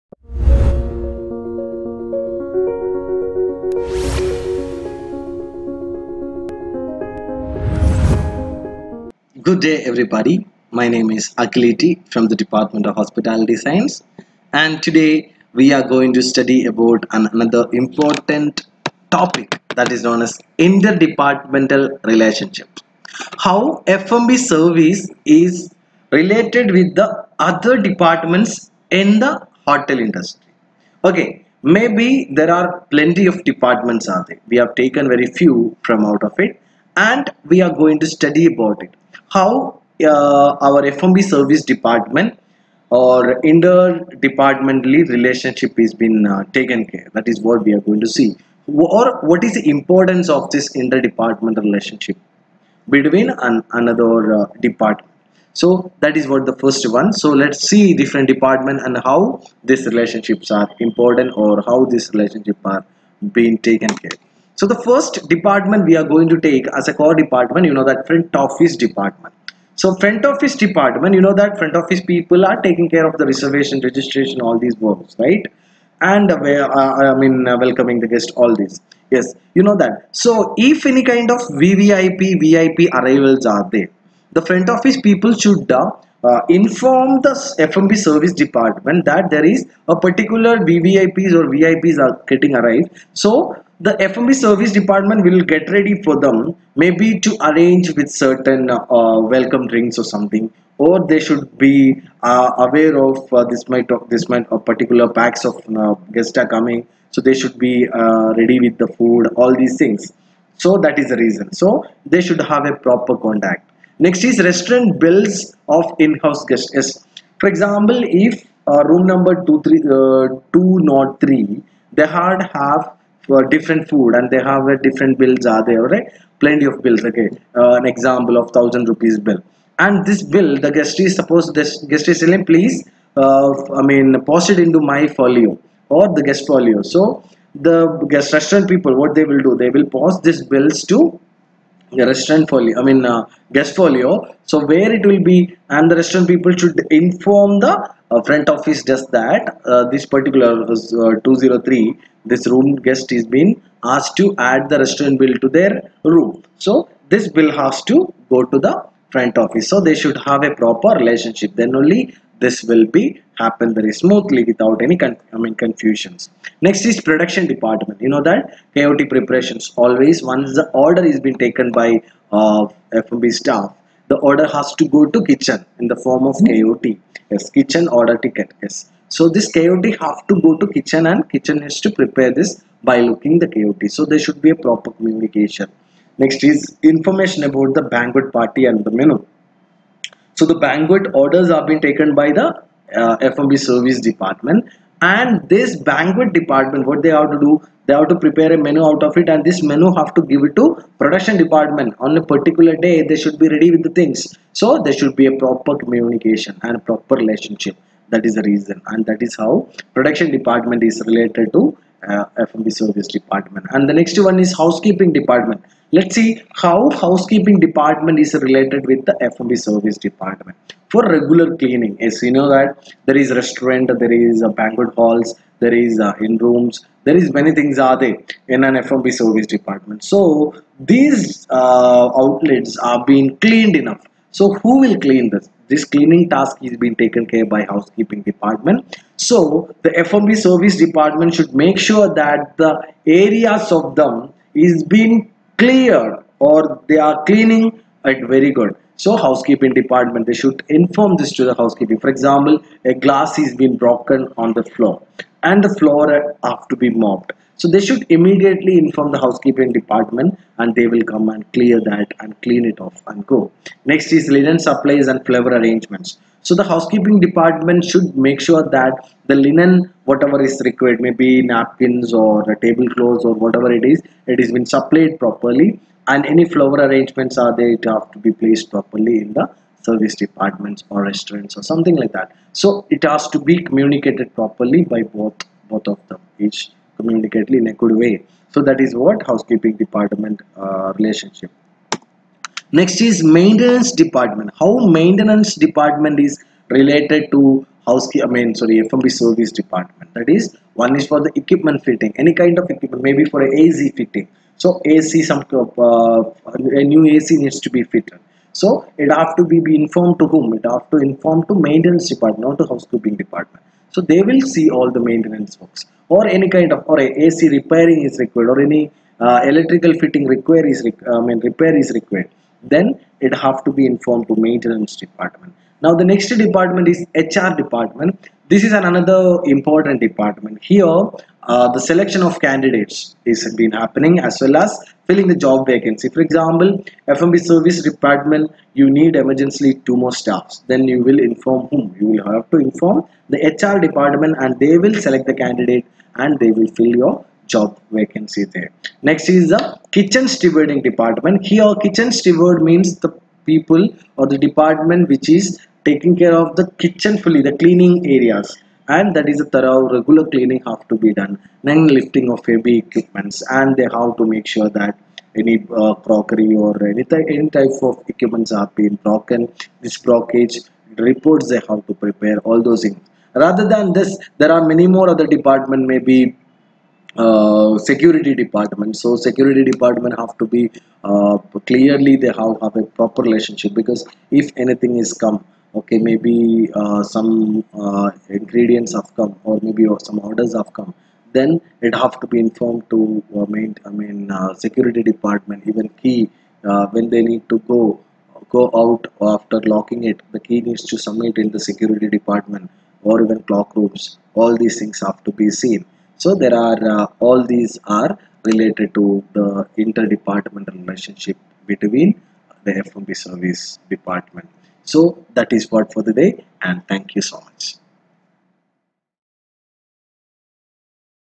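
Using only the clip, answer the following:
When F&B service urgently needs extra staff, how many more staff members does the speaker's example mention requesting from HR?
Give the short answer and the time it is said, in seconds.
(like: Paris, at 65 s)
2, at 339 s.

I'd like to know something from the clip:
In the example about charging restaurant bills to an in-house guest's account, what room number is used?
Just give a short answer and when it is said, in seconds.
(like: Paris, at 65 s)
203, at 152 s.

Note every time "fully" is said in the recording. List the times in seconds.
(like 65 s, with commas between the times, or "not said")
357 s.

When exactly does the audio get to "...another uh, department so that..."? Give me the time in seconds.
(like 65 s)
53 s.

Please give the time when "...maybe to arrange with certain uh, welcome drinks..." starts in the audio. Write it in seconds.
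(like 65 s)
96 s.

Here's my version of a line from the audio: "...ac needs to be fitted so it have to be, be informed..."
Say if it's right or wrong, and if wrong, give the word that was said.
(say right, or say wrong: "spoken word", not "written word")
right.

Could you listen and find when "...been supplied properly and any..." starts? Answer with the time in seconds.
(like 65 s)
274 s.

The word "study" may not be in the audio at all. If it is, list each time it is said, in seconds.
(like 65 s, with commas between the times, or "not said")
16 s, 38 s.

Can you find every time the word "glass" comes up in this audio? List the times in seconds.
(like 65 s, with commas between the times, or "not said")
252 s.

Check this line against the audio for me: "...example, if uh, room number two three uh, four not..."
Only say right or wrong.
wrong.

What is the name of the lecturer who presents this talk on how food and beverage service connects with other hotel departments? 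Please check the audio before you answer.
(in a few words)
Akhil ET.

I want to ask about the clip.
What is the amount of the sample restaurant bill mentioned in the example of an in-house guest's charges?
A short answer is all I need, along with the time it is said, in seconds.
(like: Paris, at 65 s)
1000 rupees, at 128 s.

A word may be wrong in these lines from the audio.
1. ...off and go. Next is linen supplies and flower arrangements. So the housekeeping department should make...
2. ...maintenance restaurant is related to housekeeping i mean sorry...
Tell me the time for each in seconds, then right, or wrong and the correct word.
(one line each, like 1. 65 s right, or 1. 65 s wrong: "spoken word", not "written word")
1. 262 s right
2. 294 s wrong: "department", not "restaurant".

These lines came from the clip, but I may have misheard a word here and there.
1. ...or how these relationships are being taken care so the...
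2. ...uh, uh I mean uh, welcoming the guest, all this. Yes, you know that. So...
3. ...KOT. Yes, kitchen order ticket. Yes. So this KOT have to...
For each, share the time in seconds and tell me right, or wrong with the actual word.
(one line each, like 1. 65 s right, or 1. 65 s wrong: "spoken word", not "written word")
1. 61 s right
2. 76 s right
3. 176 s right.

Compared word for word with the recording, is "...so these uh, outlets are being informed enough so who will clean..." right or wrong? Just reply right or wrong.
wrong.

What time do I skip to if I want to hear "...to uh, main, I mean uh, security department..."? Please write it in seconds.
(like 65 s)
392 s.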